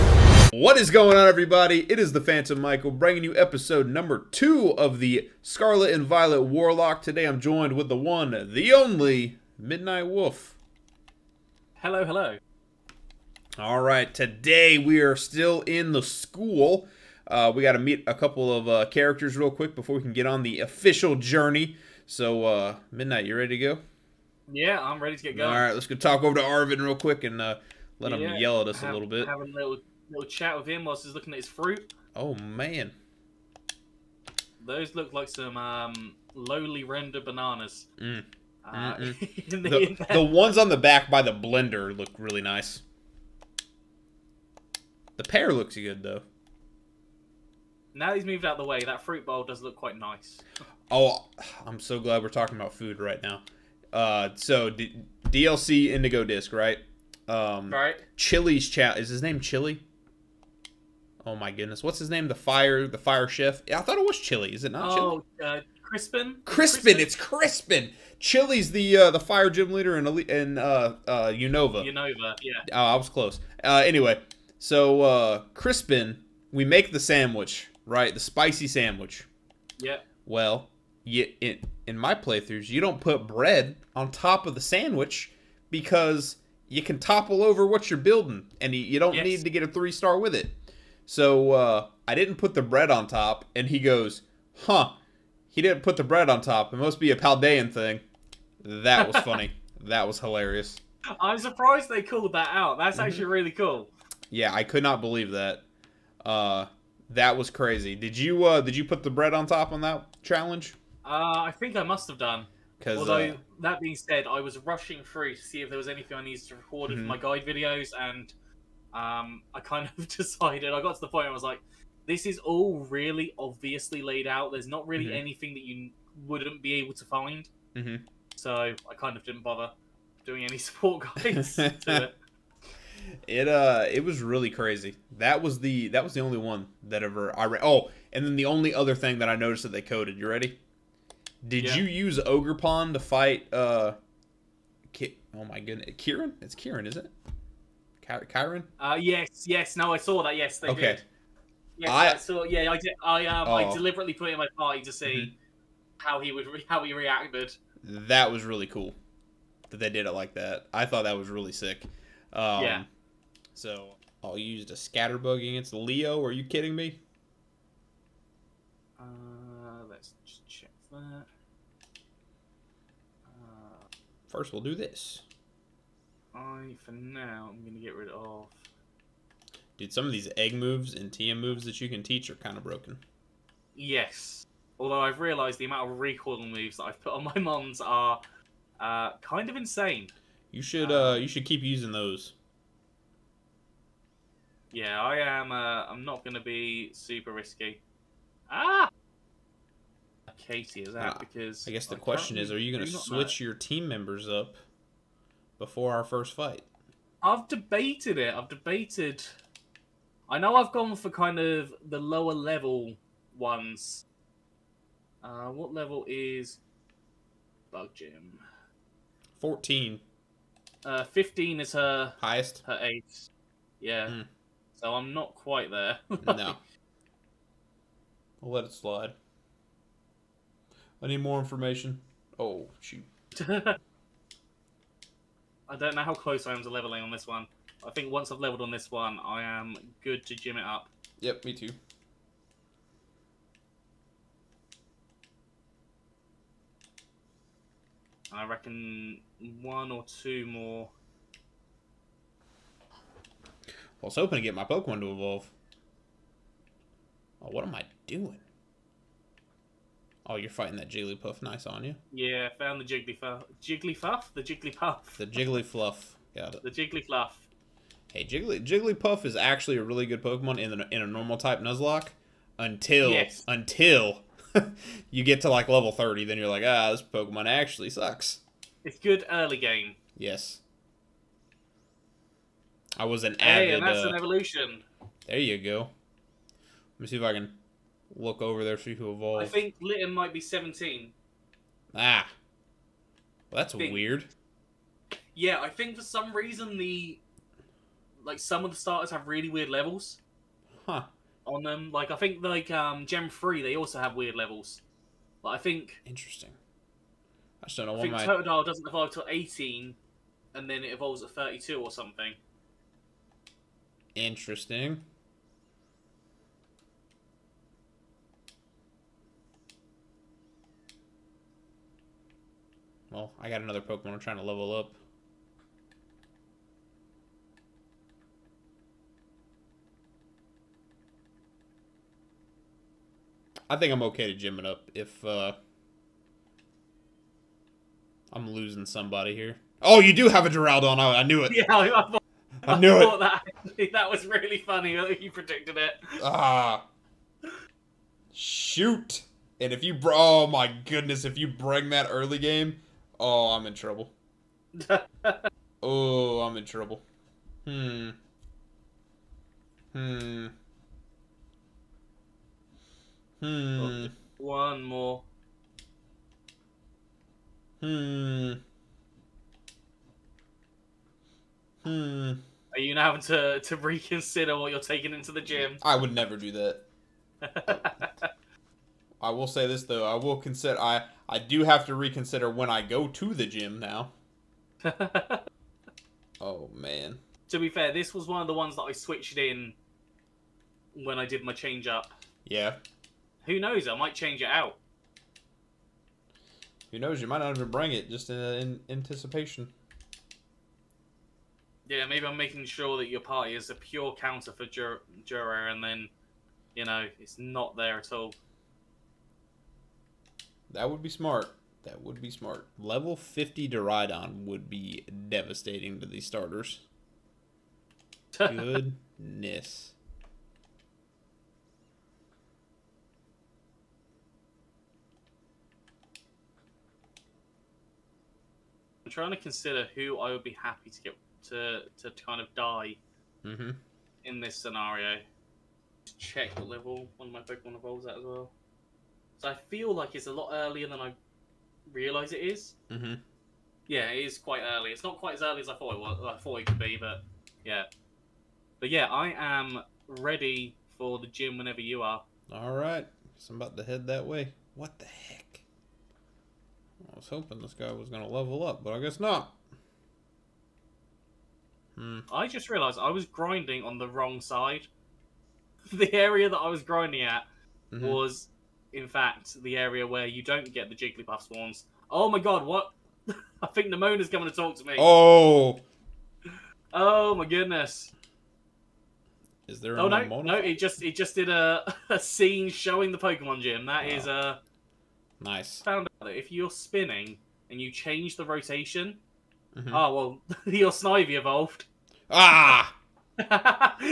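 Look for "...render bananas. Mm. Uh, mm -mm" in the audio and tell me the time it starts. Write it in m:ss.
0:36.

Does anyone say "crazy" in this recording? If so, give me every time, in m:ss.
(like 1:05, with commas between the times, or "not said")
1:47, 2:14.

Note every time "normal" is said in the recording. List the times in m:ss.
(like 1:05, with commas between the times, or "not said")
4:31.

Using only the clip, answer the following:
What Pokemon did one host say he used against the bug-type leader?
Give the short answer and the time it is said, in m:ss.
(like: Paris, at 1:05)
Scatterbug, at 2:44.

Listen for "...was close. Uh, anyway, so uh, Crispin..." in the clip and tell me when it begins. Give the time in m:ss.
1:12.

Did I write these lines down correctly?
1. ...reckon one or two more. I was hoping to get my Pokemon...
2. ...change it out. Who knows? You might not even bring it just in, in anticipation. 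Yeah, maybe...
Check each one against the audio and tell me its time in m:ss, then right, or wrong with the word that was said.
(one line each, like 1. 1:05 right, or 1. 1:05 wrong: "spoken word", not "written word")
1. 4:08 right
2. 6:34 right.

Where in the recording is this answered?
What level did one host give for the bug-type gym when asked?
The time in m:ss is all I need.
3:39.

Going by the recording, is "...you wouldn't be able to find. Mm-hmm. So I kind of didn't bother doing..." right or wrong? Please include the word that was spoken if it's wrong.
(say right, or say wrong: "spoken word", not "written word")
right.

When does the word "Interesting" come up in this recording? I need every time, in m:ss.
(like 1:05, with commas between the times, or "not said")
5:06, 5:14.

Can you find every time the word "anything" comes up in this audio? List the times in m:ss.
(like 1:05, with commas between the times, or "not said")
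1:55, 2:05.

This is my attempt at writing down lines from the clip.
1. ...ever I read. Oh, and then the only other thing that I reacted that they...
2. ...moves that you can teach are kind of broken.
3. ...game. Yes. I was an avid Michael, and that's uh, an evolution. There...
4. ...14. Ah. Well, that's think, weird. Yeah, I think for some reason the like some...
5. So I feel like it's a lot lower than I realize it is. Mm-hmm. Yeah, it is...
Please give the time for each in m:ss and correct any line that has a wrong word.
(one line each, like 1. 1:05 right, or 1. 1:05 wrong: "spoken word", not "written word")
1. 2:17 wrong: "noticed", not "reacted"
2. 3:01 right
3. 4:39 wrong: "Hey", not "Michael"
4. 4:50 wrong: "17", not "14"
5. 7:19 wrong: "earlier", not "lower".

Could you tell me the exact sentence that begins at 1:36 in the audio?
It must be a Paldean thing.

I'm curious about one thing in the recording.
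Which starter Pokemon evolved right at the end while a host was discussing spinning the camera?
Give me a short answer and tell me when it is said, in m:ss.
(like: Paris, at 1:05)
Snivy, at 8:10.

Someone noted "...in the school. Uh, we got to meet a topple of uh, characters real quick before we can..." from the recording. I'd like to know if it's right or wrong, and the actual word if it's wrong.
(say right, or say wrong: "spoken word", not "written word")
wrong: "couple", not "topple".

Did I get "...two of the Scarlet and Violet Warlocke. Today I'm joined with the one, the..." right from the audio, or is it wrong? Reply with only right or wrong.
right.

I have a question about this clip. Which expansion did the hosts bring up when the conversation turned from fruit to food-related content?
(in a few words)
Indigo Disc.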